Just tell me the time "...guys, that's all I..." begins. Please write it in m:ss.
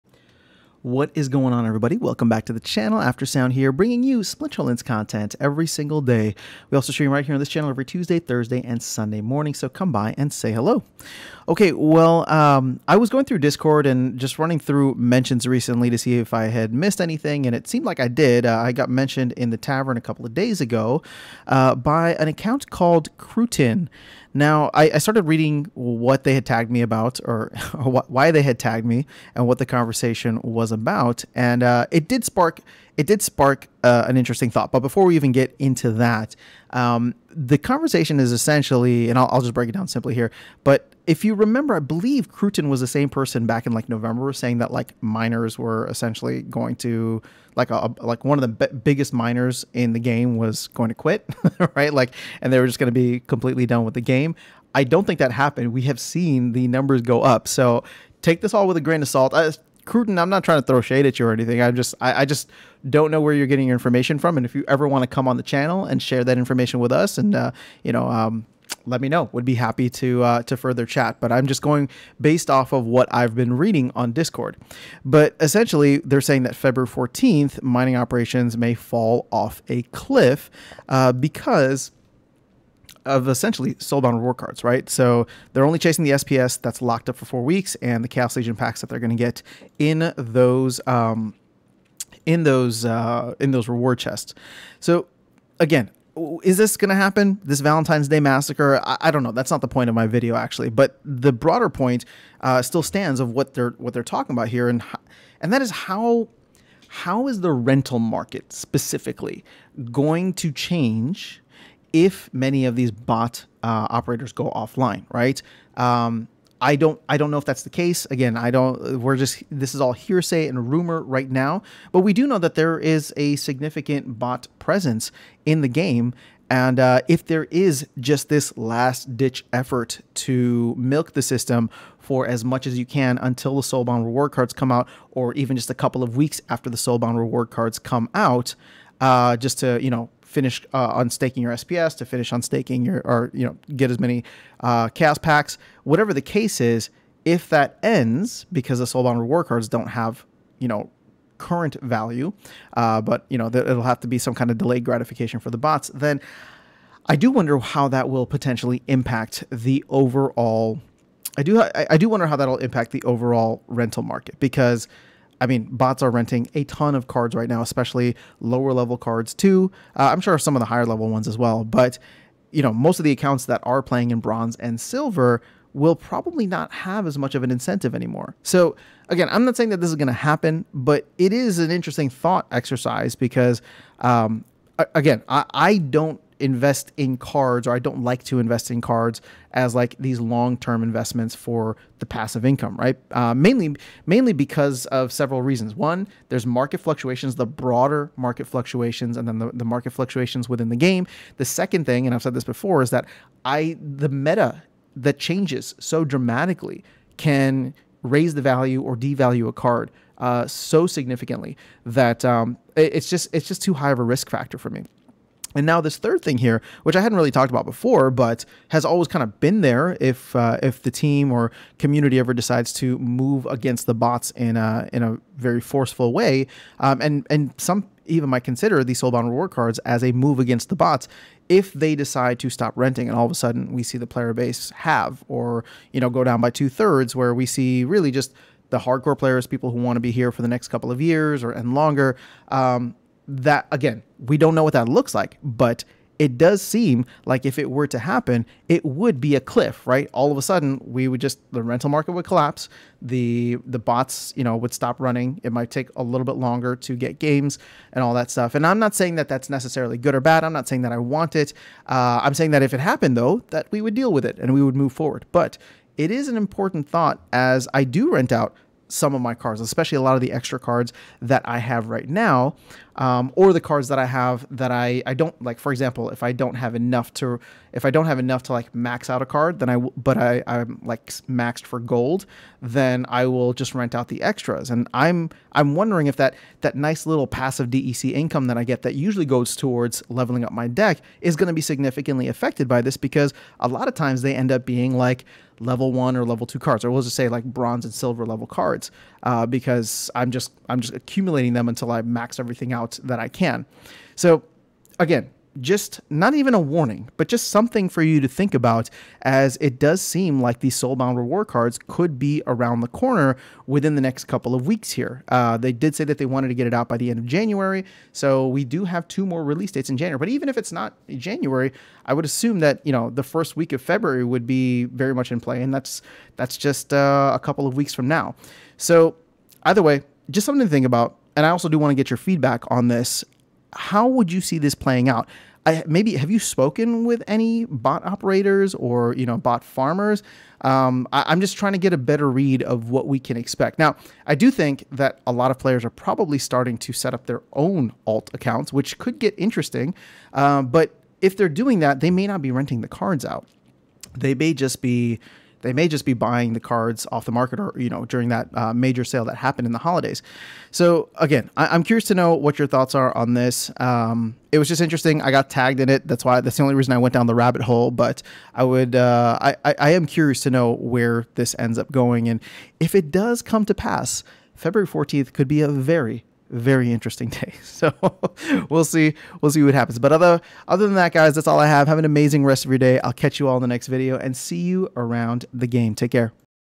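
6:21.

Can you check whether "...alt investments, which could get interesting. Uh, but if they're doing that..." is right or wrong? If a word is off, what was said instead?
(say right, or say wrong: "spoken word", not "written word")
wrong: "accounts", not "investments".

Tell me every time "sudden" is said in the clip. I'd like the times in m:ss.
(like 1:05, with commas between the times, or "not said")
3:53, 4:10.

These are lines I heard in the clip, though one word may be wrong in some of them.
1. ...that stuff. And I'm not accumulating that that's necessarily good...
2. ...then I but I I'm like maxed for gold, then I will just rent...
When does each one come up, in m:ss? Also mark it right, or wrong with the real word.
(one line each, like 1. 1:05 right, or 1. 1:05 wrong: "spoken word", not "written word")
1. 4:18 wrong: "saying", not "accumulating"
2. 4:39 right.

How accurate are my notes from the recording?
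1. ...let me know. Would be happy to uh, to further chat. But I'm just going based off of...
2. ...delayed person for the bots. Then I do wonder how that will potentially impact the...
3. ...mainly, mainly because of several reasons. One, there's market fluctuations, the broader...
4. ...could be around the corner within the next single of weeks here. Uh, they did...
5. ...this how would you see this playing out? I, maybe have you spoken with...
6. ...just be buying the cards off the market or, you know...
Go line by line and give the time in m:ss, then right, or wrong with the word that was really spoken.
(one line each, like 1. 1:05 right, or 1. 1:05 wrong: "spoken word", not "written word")
1. 1:08 right
2. 2:34 wrong: "gratification", not "person"
3. 3:13 right
4. 5:11 wrong: "couple", not "single"
5. 5:32 right
6. 5:55 right.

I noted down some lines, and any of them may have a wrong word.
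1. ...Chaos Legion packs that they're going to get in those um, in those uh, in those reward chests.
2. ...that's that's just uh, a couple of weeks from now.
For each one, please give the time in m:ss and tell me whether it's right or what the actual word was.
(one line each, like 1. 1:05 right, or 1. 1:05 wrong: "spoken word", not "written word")
1. 1:28 right
2. 5:25 right.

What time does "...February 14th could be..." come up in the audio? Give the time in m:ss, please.
6:14.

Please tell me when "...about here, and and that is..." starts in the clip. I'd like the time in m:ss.
1:44.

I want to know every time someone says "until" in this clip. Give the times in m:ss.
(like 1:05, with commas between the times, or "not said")
2:13, 5:01.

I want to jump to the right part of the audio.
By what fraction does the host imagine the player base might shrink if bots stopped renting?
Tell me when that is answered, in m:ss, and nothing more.
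3:56.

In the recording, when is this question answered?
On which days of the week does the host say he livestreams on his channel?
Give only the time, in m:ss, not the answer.
0:07.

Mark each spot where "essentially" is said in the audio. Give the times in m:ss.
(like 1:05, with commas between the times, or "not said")
0:38, 0:45, 1:15, 1:23.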